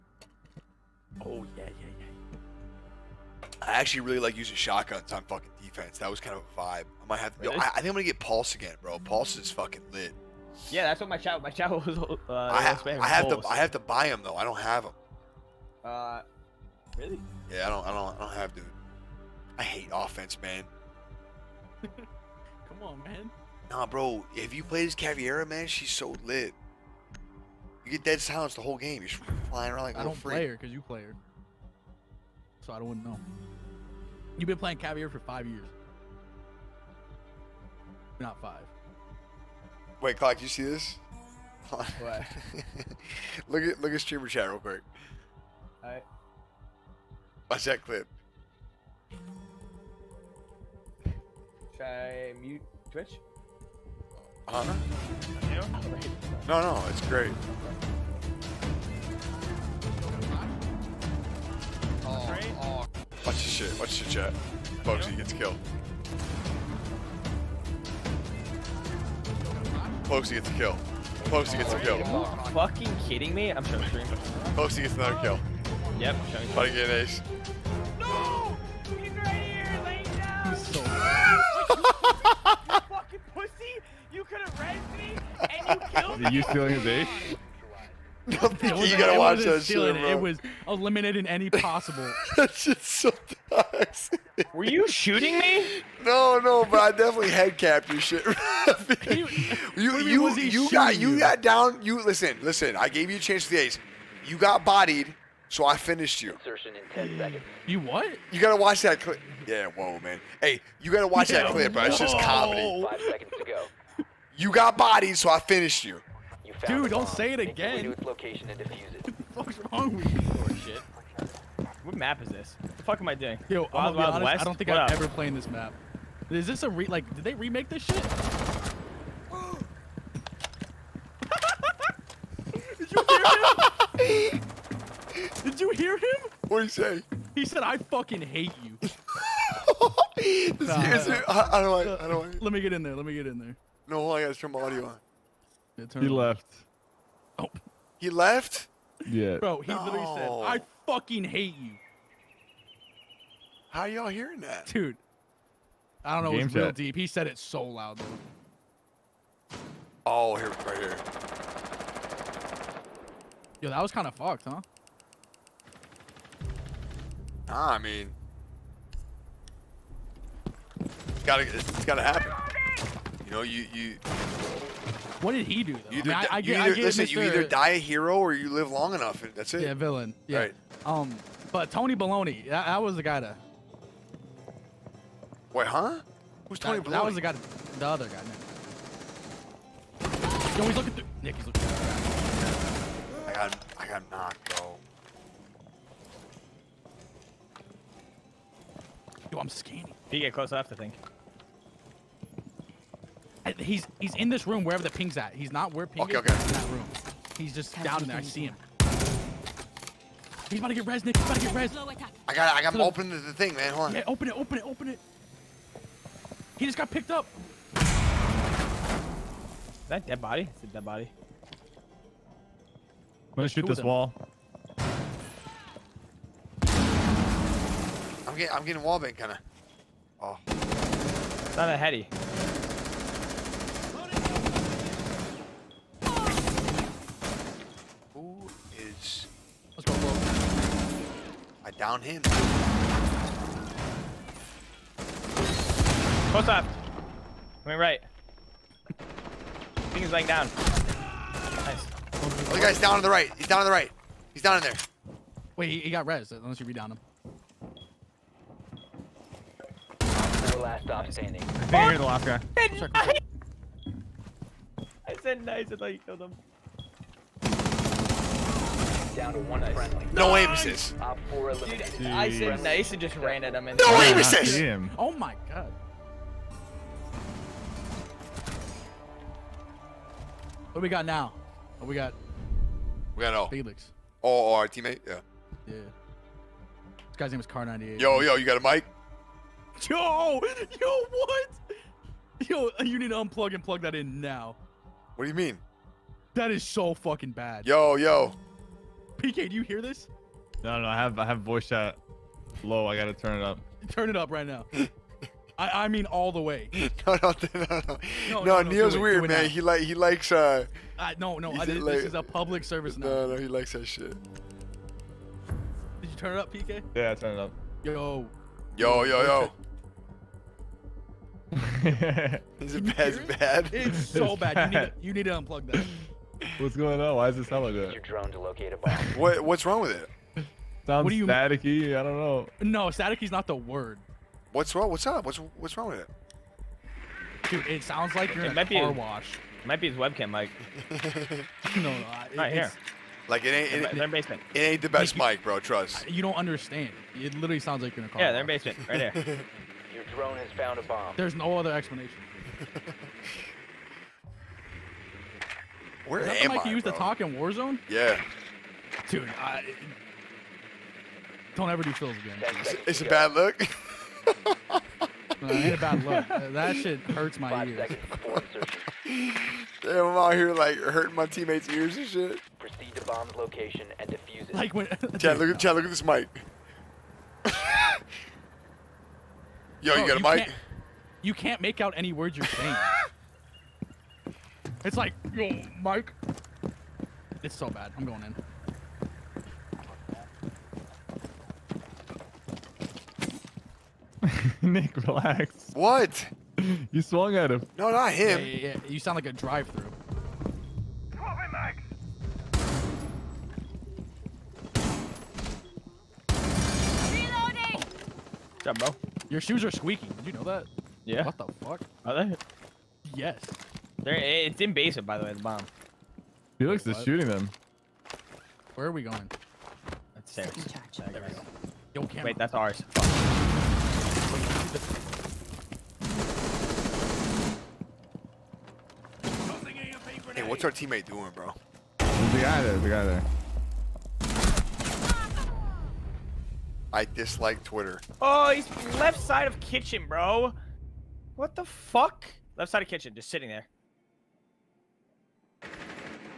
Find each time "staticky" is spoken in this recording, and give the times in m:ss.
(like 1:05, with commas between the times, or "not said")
5:31.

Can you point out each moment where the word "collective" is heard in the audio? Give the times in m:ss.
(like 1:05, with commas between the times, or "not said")
not said.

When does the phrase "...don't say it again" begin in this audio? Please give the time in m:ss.
1:56.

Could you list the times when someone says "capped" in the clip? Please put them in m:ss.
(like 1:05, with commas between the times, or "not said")
1:37.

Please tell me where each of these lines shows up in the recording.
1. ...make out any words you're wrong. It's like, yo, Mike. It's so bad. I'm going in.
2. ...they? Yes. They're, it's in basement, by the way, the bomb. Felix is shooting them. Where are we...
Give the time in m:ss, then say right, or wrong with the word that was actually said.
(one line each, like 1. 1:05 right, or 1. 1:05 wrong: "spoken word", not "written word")
1. 6:21 wrong: "saying", not "wrong"
2. 6:52 right.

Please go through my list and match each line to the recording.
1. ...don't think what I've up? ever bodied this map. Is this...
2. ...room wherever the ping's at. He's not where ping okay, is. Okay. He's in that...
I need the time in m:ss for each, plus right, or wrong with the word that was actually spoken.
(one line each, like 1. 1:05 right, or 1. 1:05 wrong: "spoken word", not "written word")
1. 2:04 wrong: "played", not "bodied"
2. 3:24 right.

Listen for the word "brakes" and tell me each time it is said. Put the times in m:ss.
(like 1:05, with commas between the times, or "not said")
not said.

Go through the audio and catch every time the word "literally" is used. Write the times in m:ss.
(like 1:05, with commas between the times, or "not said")
2:29, 5:47.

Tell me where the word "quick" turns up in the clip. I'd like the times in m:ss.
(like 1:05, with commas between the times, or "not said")
0:44.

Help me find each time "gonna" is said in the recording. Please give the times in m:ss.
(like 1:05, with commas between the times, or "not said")
0:07, 3:43.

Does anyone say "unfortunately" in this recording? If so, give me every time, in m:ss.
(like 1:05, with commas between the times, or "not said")
not said.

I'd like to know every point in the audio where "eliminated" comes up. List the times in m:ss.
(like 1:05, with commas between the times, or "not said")
1:30.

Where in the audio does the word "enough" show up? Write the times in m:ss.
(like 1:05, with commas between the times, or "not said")
2:58, 3:20.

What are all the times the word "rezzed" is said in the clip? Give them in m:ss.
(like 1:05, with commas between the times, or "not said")
1:24.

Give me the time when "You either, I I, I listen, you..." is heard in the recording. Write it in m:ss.
2:55.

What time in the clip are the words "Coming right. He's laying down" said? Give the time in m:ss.
4:07.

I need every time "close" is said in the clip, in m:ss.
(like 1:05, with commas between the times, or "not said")
3:20, 4:02.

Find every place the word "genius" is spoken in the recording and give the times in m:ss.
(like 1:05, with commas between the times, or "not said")
not said.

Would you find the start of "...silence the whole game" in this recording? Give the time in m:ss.
0:28.